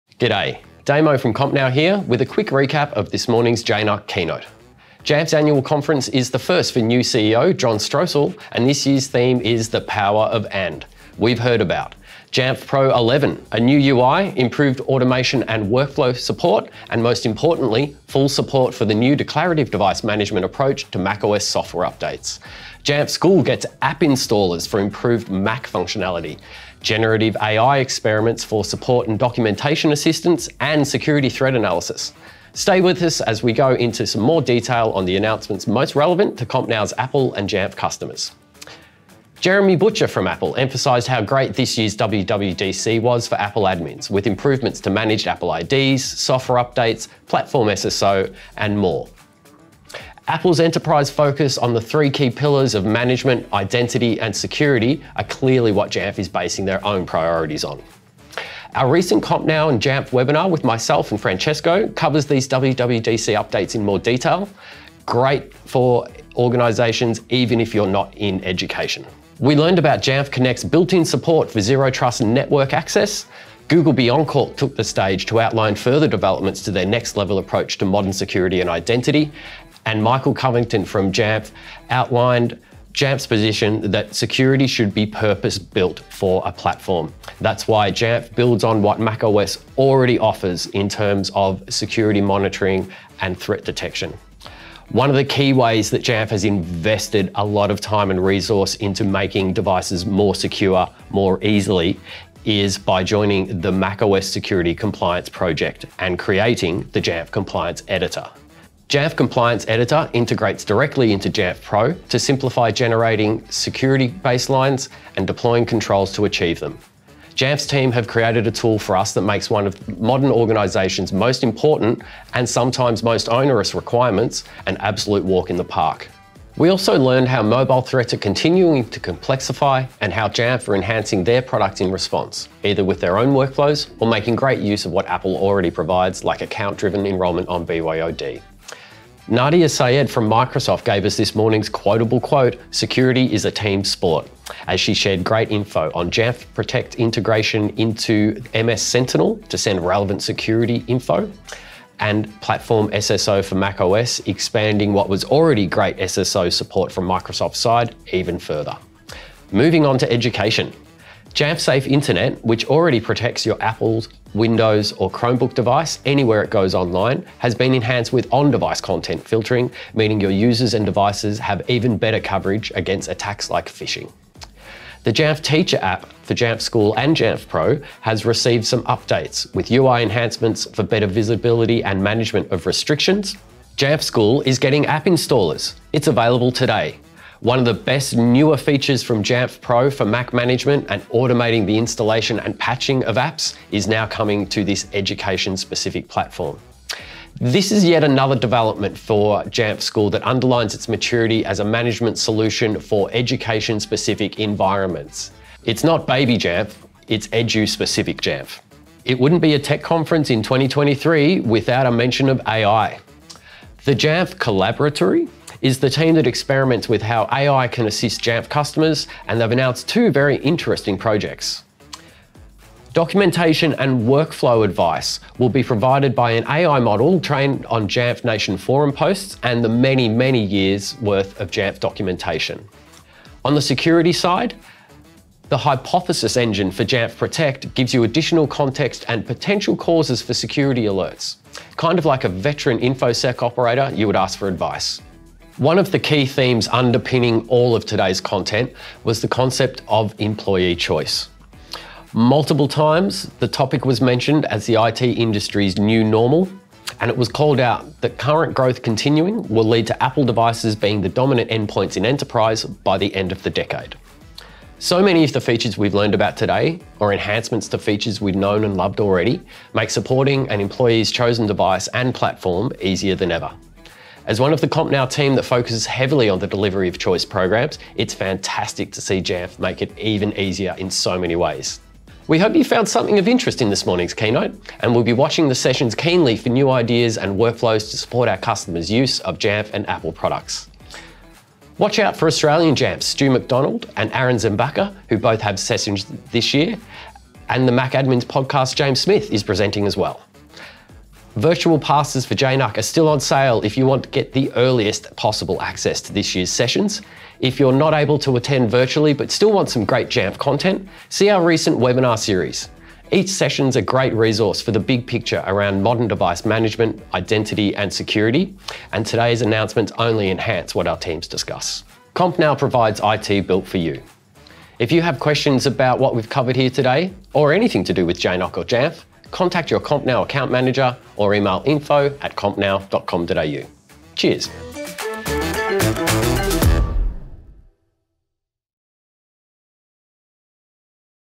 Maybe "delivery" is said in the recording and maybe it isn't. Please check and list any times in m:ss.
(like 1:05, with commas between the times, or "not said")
4:36.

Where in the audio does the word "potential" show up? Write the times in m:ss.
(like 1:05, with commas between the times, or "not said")
3:59.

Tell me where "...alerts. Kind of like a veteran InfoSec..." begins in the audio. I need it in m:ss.
4:00.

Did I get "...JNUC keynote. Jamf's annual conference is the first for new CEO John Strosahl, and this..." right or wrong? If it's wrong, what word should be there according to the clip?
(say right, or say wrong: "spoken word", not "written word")
right.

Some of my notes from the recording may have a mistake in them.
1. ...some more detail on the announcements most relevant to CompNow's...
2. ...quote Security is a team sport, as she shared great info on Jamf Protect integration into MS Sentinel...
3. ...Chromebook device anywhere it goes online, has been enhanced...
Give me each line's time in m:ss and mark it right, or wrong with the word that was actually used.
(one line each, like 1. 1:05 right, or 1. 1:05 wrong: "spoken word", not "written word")
1. 0:34 right
2. 2:22 right
3. 2:45 right.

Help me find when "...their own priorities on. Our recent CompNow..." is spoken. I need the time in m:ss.
0:56.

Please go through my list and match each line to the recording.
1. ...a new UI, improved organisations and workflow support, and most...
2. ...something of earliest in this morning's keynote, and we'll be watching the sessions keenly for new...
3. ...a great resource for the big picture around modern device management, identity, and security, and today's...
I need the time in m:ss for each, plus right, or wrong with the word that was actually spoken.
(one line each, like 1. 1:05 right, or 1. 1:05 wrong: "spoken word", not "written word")
1. 0:13 wrong: "automation", not "organisations"
2. 4:42 wrong: "interest", not "earliest"
3. 5:13 right.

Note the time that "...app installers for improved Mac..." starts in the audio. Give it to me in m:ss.
0:23.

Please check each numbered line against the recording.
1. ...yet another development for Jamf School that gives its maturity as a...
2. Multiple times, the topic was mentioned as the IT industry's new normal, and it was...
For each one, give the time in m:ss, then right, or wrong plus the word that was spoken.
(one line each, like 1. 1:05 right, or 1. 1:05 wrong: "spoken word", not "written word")
1. 3:17 wrong: "underlines", not "gives"
2. 4:12 right.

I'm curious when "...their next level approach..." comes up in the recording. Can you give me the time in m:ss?
1:16.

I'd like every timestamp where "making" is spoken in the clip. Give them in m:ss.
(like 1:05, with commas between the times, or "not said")
1:39, 2:14.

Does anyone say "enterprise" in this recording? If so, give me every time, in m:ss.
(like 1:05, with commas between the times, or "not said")
0:50, 4:22.